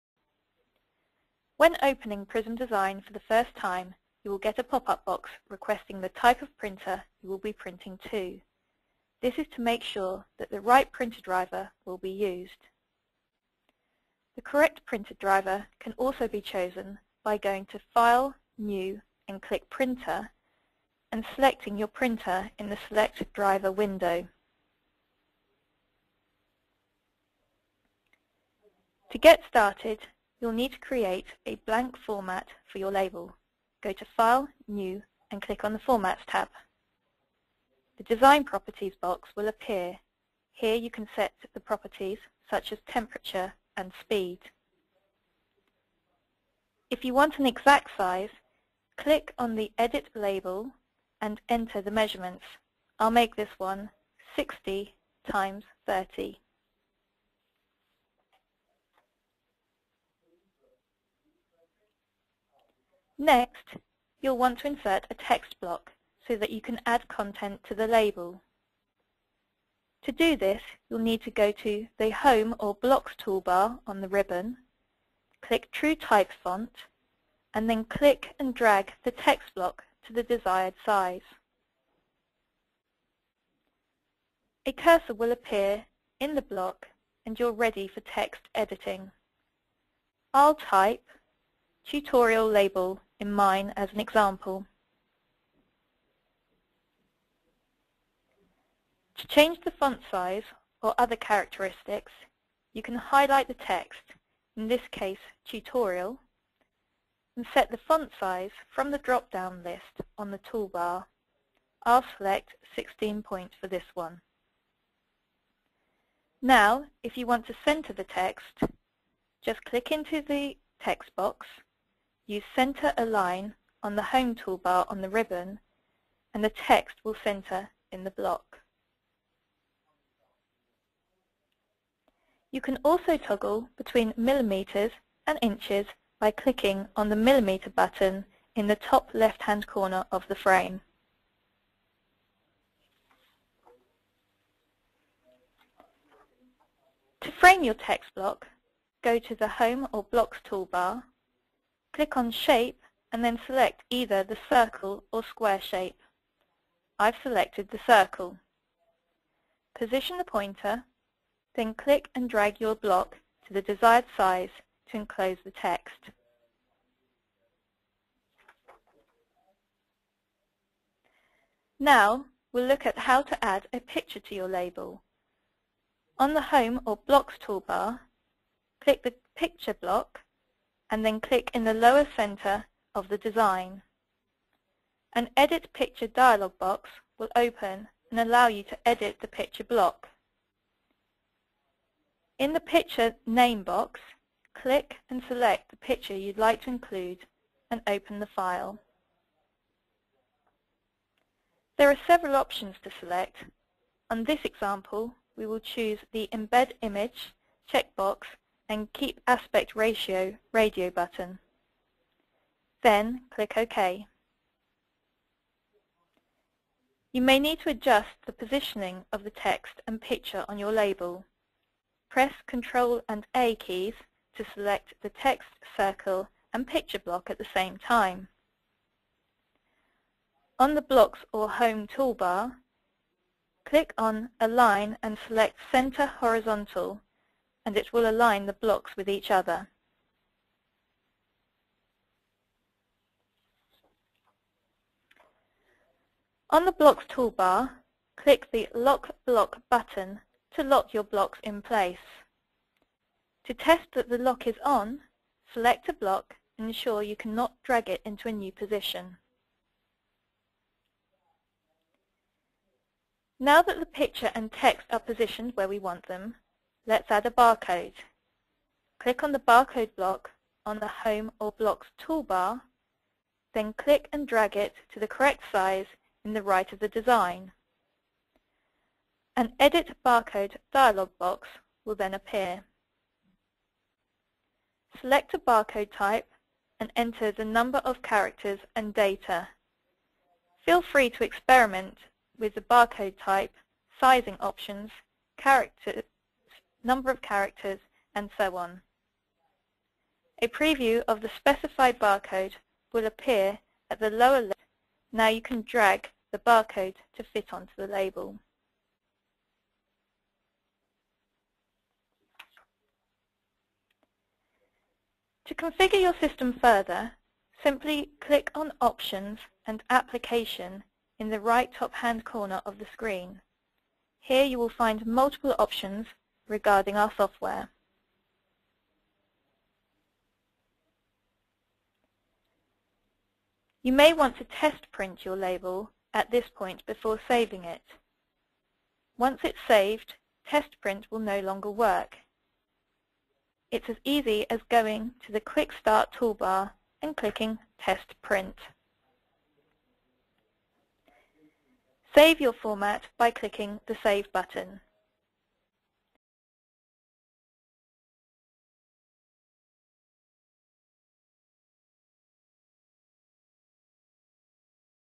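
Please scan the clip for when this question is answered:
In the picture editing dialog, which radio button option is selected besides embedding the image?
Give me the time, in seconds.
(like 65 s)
208 s.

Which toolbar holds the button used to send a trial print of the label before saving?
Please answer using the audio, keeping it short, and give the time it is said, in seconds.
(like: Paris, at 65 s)
Quick Start toolbar, at 345 s.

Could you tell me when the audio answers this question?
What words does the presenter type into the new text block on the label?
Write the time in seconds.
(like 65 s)
91 s.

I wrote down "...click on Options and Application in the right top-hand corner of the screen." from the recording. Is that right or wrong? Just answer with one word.
right.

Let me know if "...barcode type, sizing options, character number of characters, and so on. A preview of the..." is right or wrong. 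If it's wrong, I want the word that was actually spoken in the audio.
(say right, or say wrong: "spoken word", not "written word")
right.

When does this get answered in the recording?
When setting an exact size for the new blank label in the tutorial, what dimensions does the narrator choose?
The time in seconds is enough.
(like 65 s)
54 s.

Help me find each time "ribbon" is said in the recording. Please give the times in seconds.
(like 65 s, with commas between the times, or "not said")
74 s, 125 s.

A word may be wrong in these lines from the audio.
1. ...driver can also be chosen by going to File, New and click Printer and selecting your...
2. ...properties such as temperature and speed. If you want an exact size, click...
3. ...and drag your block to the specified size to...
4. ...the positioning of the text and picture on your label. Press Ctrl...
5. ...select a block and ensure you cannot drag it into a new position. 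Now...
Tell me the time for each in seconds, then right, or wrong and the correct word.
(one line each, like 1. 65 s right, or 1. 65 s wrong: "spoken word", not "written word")
1. 15 s right
2. 41 s right
3. 162 s wrong: "desired", not "specified"
4. 218 s right
5. 255 s right.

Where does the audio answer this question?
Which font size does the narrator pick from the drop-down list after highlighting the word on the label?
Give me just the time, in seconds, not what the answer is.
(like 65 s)
112 s.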